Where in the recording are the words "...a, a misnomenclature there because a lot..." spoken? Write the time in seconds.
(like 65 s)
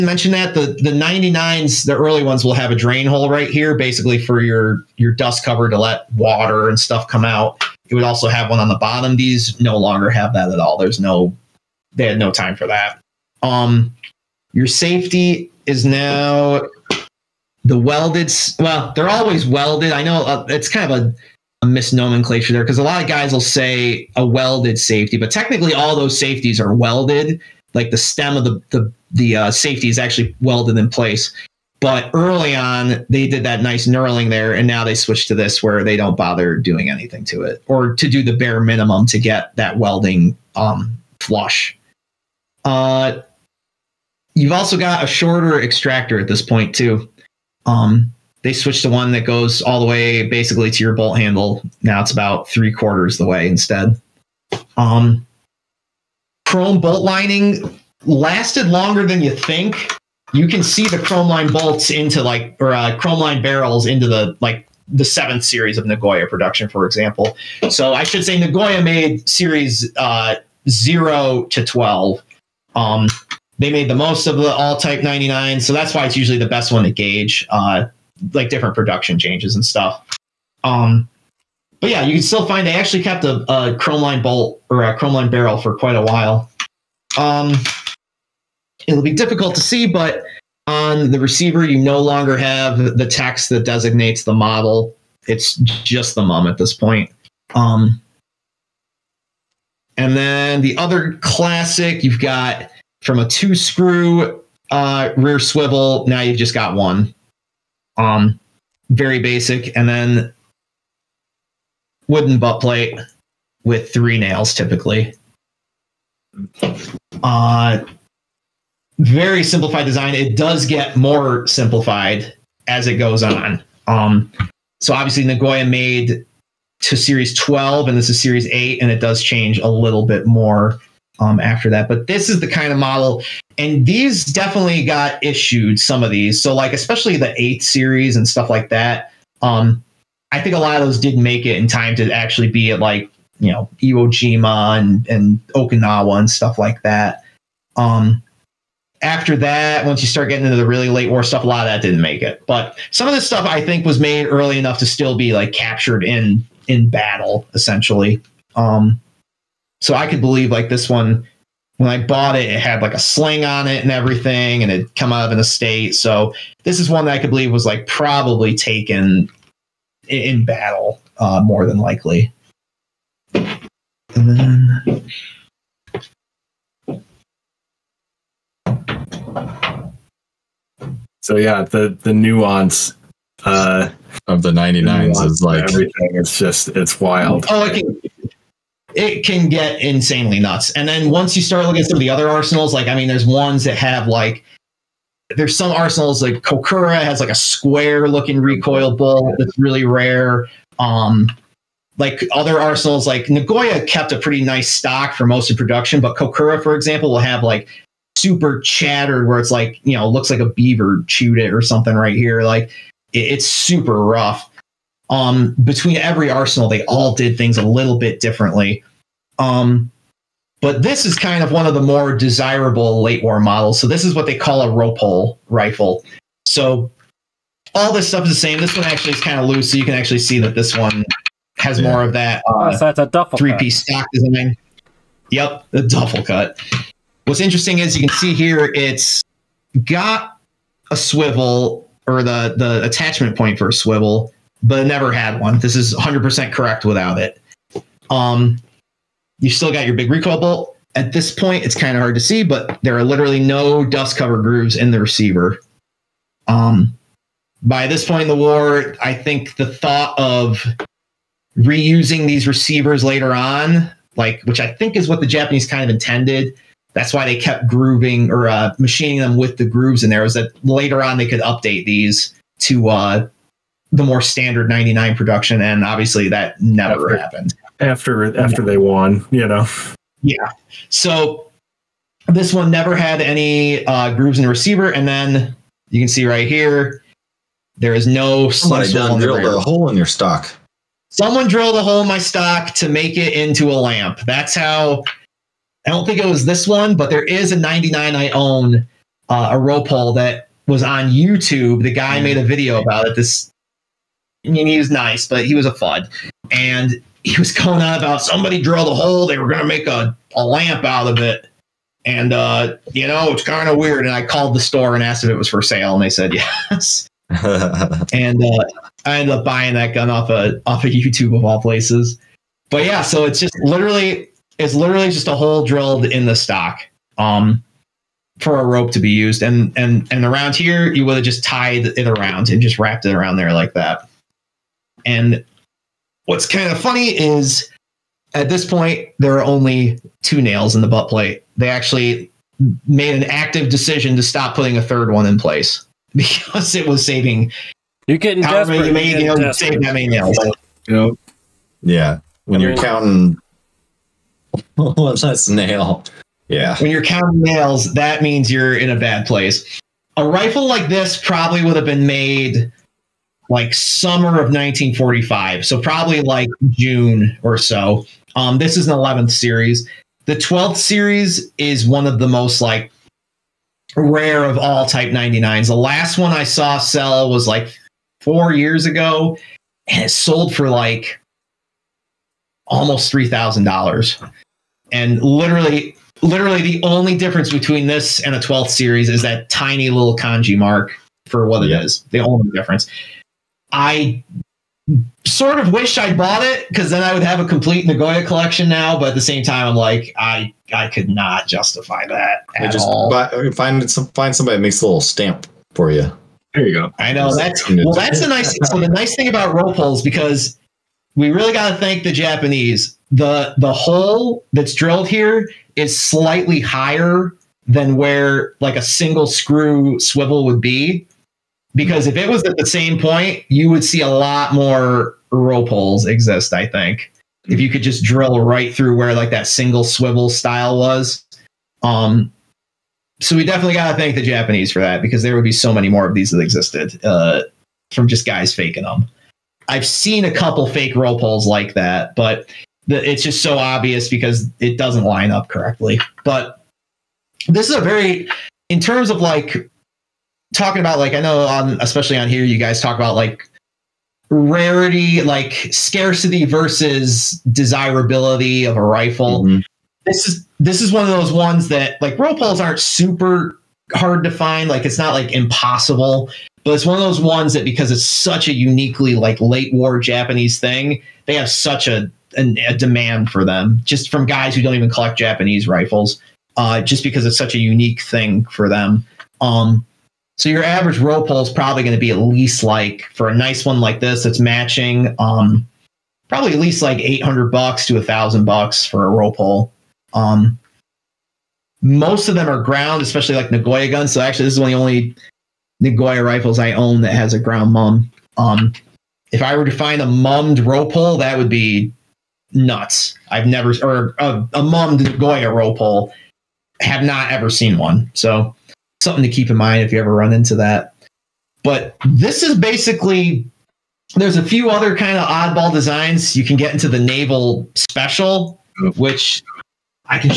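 21 s.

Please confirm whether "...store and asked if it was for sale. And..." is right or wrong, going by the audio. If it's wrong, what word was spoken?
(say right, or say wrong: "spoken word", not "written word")
right.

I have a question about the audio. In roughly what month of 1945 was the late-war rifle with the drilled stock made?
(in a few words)
June.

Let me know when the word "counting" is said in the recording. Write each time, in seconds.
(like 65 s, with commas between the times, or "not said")
352 s, 357 s.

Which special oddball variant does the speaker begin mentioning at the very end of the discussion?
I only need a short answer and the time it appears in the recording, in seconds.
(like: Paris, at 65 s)
Naval special, at 516 s.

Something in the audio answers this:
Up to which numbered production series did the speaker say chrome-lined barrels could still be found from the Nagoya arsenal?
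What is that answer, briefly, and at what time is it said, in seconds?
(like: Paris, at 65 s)
7th series, at 65 s.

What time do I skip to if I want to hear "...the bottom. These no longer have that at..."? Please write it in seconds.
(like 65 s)
8 s.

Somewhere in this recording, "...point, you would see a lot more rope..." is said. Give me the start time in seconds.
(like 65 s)
422 s.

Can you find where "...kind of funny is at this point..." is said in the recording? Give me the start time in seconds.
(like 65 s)
336 s.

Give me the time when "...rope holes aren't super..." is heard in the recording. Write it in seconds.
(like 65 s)
462 s.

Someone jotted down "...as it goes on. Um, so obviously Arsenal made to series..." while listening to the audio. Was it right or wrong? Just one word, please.
wrong.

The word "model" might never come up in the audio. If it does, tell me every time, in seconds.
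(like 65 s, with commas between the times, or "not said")
94 s, 132 s, 223 s.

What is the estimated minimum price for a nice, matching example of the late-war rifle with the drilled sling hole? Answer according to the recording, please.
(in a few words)
$800.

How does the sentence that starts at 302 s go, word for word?
made a video about it this I mean, he was nice, but he was a fud.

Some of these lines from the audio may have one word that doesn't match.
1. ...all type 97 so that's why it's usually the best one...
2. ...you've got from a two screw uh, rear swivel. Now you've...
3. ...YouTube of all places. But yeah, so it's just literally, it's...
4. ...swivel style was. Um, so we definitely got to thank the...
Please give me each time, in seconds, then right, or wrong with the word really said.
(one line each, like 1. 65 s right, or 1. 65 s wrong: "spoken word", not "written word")
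1. 74 s wrong: "99", not "97"
2. 102 s right
3. 320 s right
4. 429 s right.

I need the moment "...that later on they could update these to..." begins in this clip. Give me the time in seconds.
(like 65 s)
270 s.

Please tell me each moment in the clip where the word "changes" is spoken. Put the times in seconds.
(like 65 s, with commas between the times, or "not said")
79 s, 129 s.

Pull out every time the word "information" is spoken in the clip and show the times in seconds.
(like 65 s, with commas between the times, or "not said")
not said.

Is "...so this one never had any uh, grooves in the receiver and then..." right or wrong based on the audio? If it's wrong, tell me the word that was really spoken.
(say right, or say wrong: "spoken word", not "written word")
right.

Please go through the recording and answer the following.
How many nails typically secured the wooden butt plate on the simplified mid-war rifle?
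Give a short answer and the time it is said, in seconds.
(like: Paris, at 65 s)
3, at 113 s.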